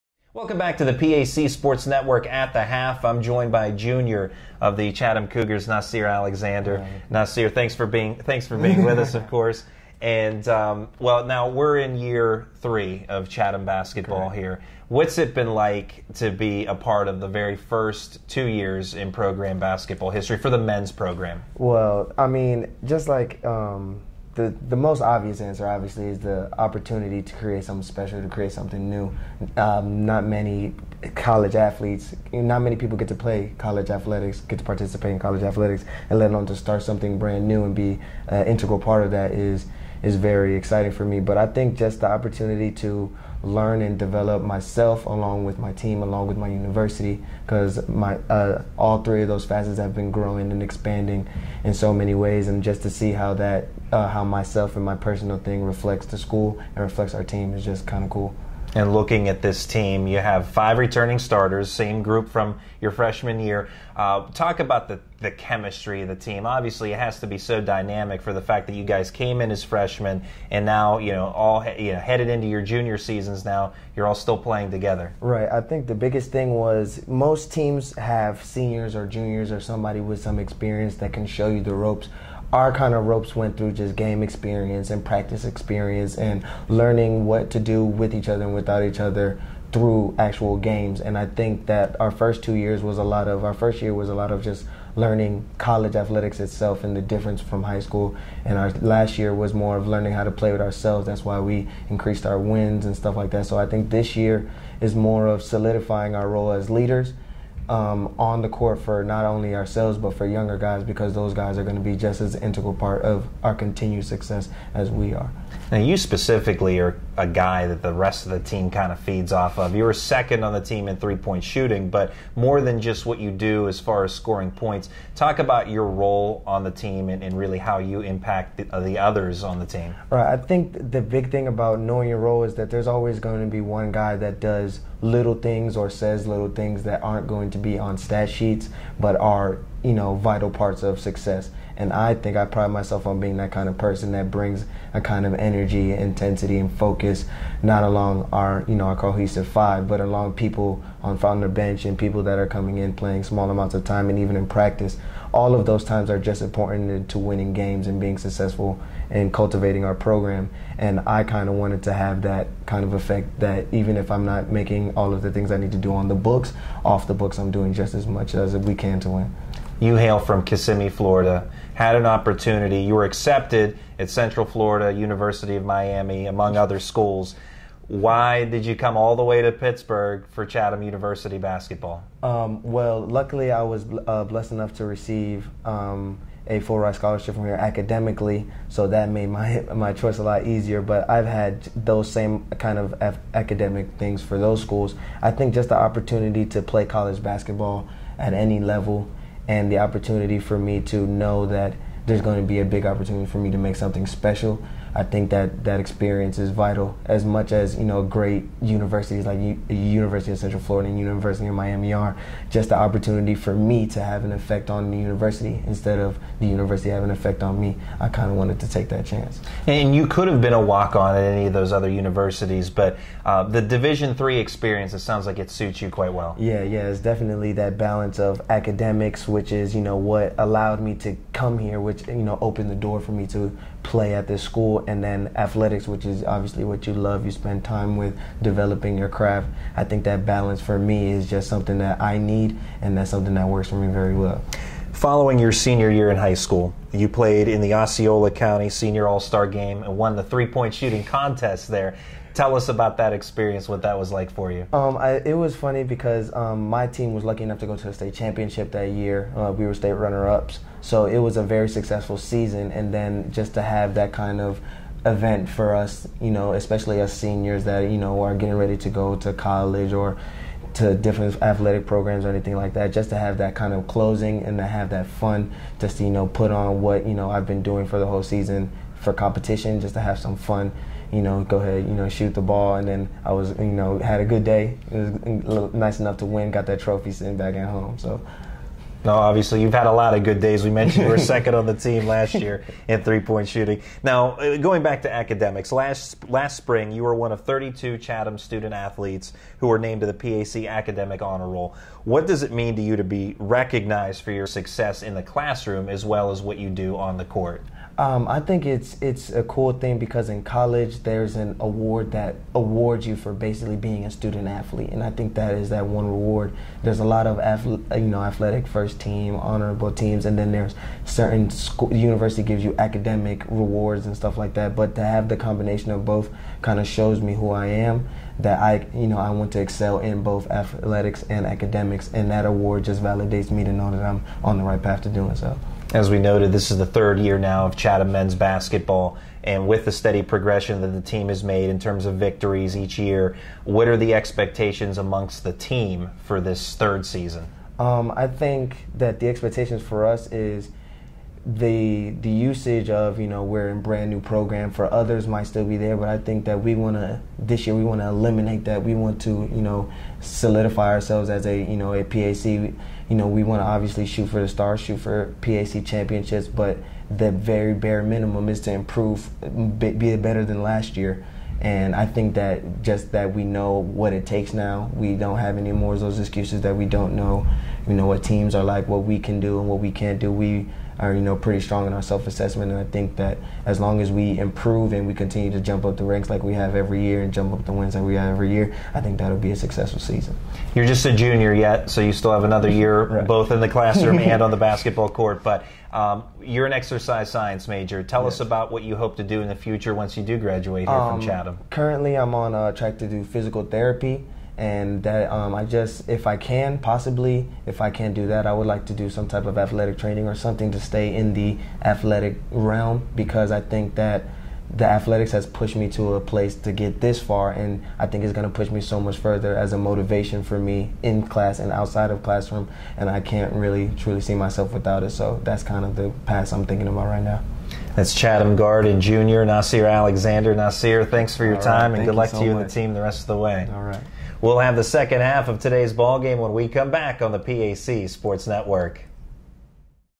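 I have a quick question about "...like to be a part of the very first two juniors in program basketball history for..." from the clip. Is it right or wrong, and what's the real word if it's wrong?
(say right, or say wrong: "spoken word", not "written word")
wrong: "years", not "juniors".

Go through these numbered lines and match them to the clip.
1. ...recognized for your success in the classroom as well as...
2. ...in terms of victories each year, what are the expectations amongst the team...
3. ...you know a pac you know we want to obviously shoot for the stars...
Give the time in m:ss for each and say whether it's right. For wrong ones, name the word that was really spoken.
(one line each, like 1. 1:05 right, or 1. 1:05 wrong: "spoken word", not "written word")
1. 5:03 right
2. 5:41 right
3. 6:01 right.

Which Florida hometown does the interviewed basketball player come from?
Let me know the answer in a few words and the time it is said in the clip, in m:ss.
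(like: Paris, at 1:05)
Kissimmee, at 2:50.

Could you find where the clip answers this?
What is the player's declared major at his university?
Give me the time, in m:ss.
6:36.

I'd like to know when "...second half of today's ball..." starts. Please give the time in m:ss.
7:14.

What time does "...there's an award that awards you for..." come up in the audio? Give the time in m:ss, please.
5:11.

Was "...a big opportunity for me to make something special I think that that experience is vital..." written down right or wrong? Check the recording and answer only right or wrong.
right.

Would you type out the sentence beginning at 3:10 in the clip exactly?
But I've had those same kind of af- academic things for those schools.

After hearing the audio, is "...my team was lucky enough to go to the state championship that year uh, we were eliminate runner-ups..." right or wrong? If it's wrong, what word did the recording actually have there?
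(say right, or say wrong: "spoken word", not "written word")
wrong: "state", not "eliminate".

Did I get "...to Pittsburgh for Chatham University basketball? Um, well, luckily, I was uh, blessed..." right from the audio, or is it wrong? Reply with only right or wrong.
right.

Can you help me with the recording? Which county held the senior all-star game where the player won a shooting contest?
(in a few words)
Osceola County.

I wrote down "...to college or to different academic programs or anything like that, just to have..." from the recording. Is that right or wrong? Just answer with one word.
wrong.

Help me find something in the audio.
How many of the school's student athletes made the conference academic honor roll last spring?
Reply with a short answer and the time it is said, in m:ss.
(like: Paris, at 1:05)
32, at 4:57.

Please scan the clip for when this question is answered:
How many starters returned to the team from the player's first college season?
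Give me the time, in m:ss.
1:00.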